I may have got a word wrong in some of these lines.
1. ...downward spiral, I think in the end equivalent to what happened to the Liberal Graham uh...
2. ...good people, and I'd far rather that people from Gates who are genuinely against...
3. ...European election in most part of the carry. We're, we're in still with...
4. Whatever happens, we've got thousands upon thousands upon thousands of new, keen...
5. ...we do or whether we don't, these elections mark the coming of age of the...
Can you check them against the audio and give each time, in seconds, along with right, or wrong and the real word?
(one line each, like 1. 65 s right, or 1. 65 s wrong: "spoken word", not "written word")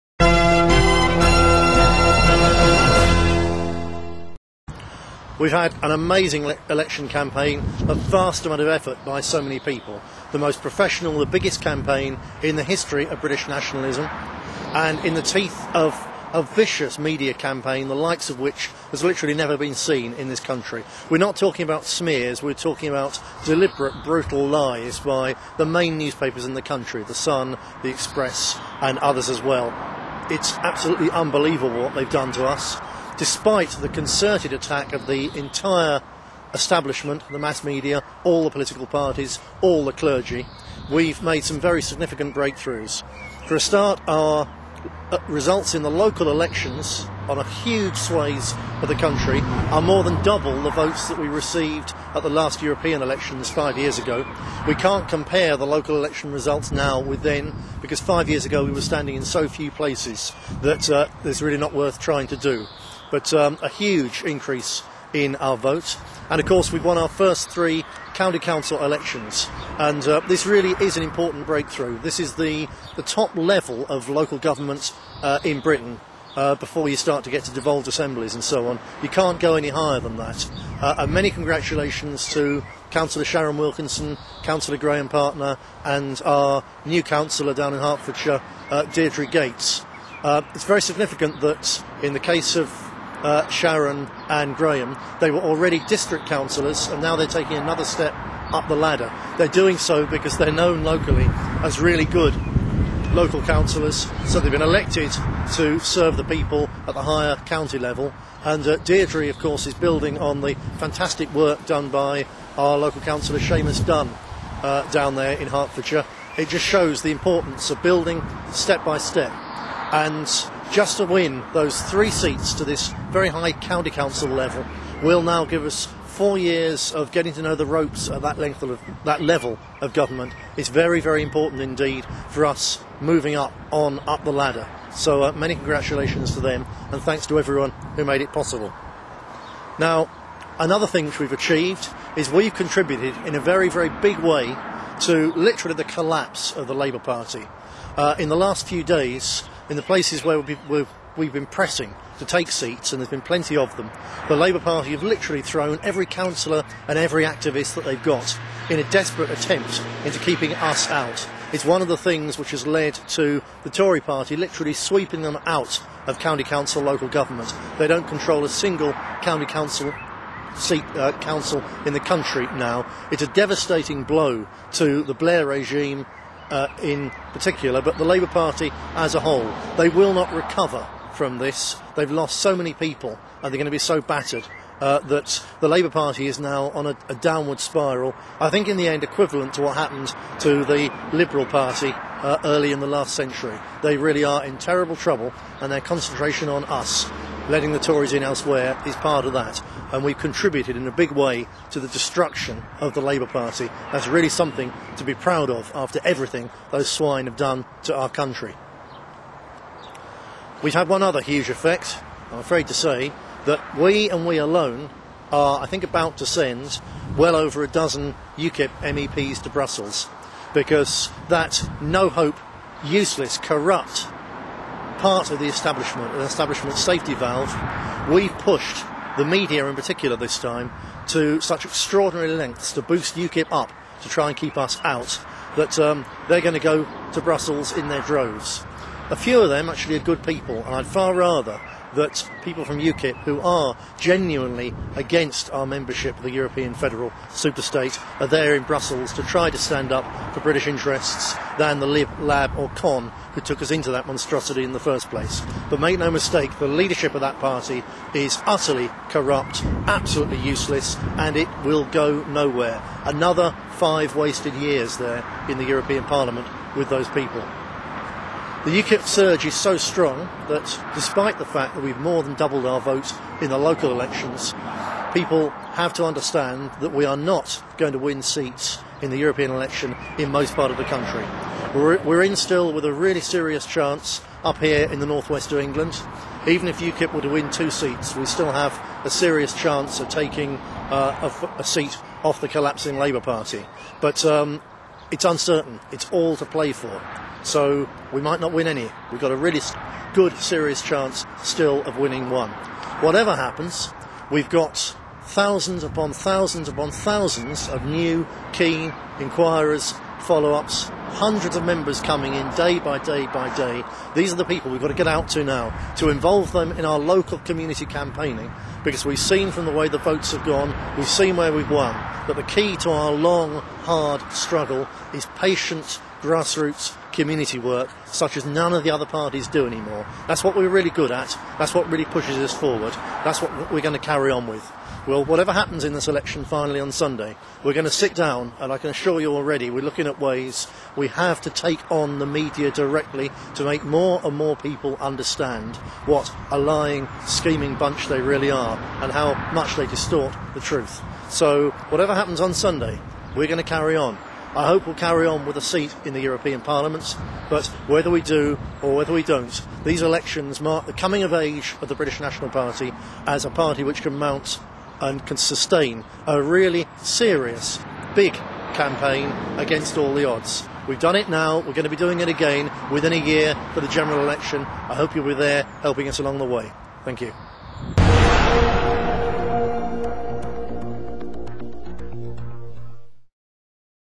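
1. 187 s wrong: "Party", not "Graham"
2. 239 s wrong: "UKIP", not "Gates"
3. 279 s wrong: "country", not "carry"
4. 303 s right
5. 358 s right.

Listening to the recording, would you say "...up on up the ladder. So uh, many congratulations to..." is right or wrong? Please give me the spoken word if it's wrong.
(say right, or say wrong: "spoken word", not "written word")
right.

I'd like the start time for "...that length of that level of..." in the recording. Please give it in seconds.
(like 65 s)
128 s.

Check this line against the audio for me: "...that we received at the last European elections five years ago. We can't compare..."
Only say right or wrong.
right.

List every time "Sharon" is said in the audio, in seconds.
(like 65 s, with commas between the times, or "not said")
83 s, 93 s.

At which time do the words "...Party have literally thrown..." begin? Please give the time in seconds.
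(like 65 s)
154 s.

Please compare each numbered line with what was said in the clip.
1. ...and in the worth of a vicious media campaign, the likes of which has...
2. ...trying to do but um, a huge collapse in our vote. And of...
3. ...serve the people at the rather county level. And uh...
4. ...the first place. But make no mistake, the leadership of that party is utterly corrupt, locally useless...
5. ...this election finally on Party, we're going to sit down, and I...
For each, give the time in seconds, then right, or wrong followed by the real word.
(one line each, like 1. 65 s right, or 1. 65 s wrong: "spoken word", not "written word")
1. 14 s wrong: "teeth", not "worth"
2. 61 s wrong: "increase", not "collapse"
3. 105 s wrong: "higher", not "rather"
4. 254 s wrong: "absolutely", not "locally"
5. 335 s wrong: "Sunday", not "Party".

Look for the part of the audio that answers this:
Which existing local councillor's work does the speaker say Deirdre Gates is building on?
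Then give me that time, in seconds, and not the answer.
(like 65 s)
113 s.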